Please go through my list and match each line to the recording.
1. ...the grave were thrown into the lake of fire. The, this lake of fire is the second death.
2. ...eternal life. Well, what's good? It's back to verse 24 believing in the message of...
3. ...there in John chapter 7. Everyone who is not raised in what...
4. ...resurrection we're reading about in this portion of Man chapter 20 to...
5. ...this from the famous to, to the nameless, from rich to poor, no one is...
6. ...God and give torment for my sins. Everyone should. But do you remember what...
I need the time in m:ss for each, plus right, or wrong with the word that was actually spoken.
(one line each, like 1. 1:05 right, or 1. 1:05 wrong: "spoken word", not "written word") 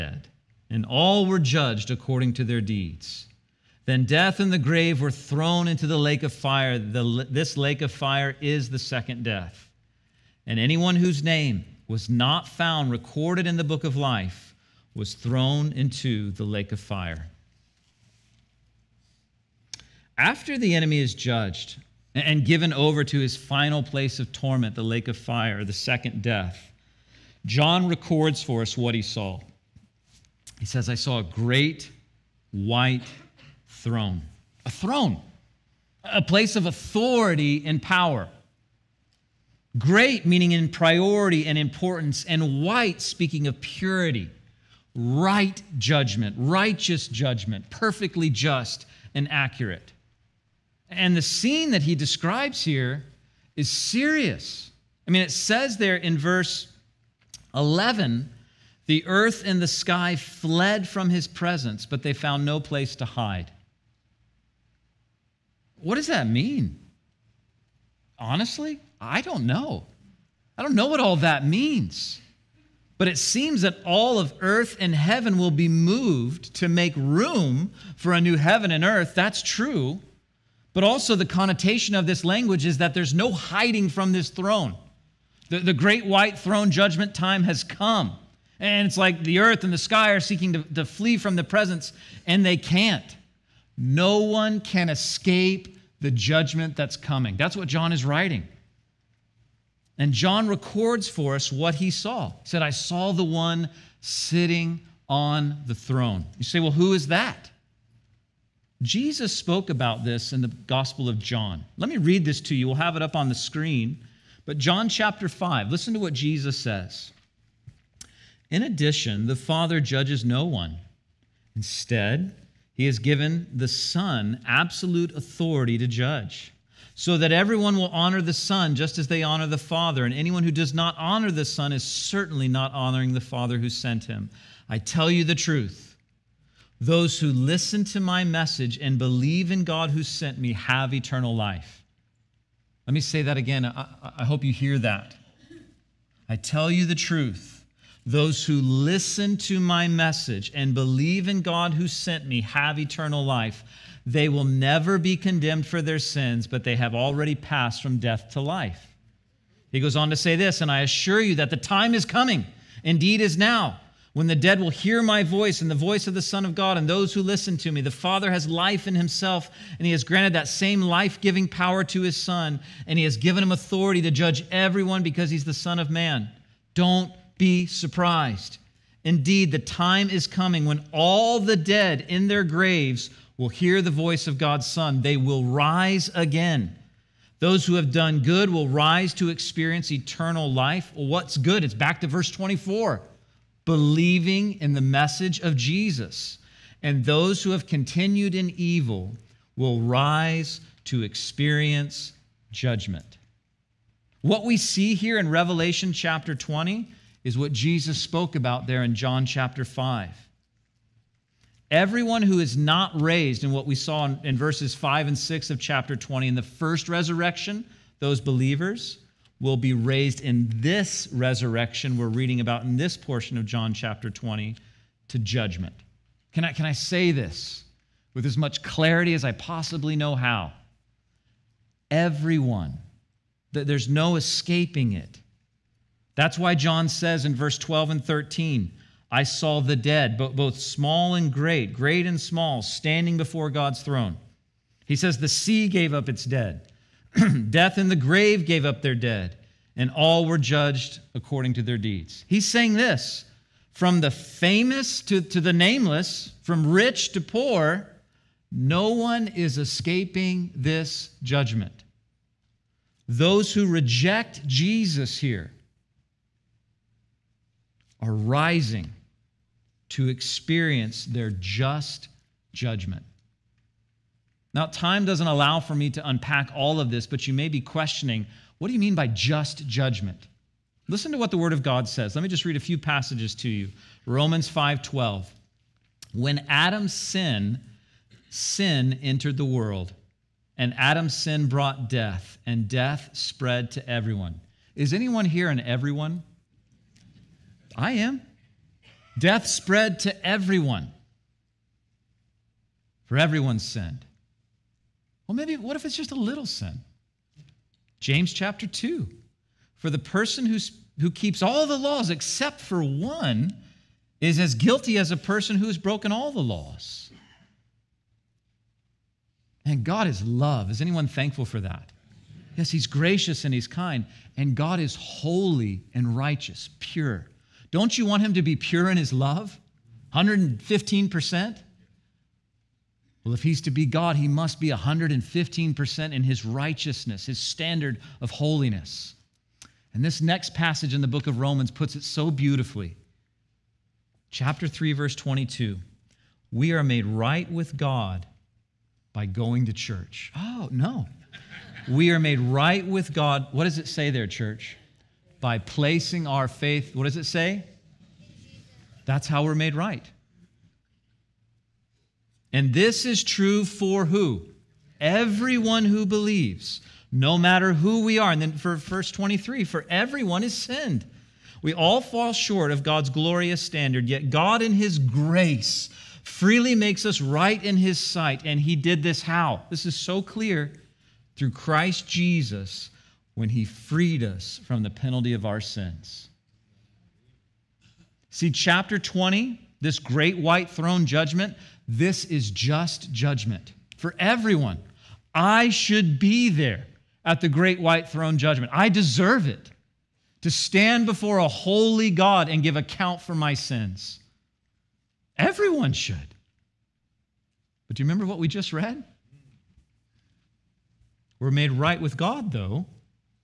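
1. 0:04 right
2. 3:09 right
3. 3:28 wrong: "5", not "7"
4. 3:41 wrong: "John", not "Man"
5. 4:12 right
6. 6:42 wrong: "account", not "torment".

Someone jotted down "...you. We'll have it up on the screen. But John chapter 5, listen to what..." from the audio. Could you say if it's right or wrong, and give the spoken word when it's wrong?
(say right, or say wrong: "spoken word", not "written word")
right.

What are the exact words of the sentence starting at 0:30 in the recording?
He says, I saw a great white throne.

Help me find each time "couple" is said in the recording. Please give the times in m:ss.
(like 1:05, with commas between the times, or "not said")
not said.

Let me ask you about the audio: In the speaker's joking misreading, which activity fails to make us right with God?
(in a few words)
going to church.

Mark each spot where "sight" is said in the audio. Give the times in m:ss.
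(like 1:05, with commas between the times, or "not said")
6:17.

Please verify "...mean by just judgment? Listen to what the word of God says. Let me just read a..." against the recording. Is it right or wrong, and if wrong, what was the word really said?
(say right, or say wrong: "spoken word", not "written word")
right.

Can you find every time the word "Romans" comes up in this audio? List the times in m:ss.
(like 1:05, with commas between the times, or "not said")
4:44, 5:41.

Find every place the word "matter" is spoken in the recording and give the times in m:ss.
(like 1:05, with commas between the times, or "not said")
6:07.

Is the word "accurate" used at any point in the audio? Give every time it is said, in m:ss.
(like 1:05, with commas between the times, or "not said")
0:49.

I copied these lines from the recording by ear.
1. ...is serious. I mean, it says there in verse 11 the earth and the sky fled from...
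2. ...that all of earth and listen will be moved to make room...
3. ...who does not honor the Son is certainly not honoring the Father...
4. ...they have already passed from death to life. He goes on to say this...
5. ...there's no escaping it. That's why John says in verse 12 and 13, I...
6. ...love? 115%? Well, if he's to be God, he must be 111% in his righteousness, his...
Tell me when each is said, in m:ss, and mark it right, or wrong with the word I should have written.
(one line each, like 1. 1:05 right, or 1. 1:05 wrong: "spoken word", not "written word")
1. 0:53 right
2. 1:13 wrong: "heaven", not "listen"
3. 2:10 right
4. 2:36 right
5. 3:53 right
6. 5:29 wrong: "115", not "111".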